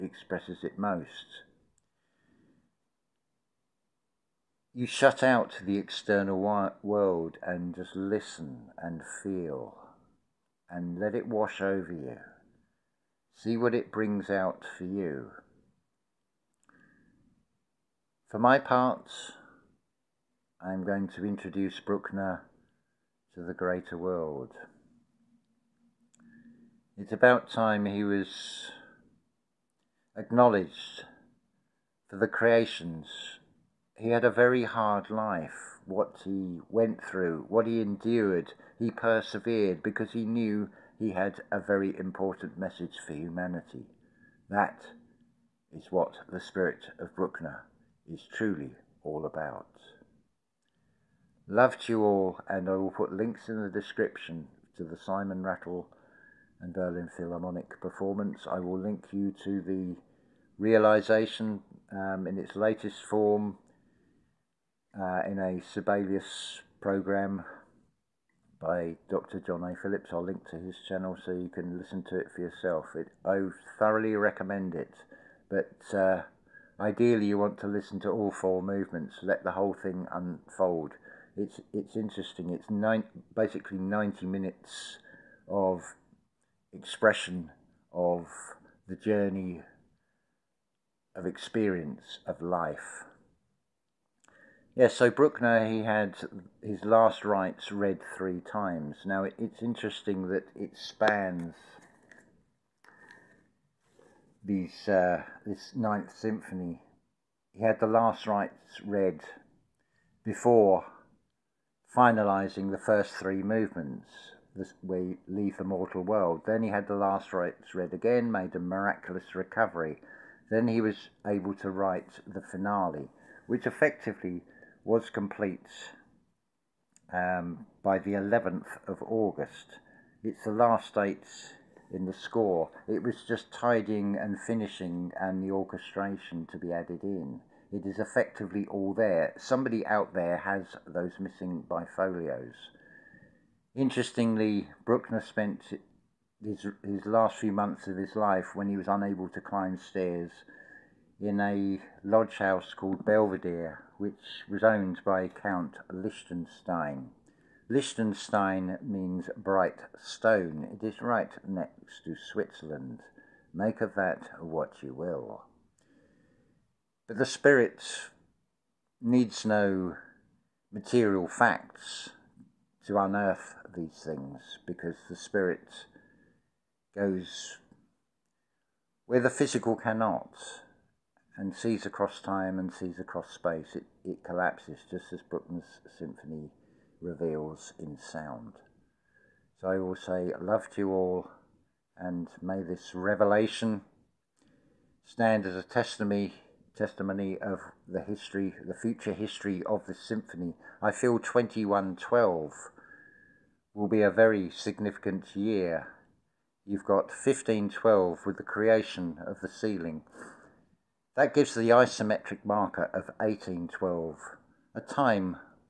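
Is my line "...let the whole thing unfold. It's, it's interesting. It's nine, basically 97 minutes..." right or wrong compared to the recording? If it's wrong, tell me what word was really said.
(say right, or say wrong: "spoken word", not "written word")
wrong: "90", not "97".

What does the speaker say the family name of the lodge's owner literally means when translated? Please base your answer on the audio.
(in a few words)
bright stone.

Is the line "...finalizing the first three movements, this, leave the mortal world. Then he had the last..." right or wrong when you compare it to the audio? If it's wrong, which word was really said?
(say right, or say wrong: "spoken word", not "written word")
right.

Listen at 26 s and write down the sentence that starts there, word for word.
It's about time he was acknowledged for the creations he had a very hard life.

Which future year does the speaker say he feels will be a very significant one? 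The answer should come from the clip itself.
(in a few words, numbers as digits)
2112.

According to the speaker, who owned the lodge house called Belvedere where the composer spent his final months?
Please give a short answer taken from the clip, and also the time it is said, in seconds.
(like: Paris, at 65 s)
Count Liechtenstein, at 155 s.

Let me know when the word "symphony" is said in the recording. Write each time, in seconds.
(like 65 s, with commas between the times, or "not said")
106 s, 185 s, 199 s.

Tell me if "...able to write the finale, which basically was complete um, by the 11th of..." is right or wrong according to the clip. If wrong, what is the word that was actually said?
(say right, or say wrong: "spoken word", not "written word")
wrong: "effectively", not "basically".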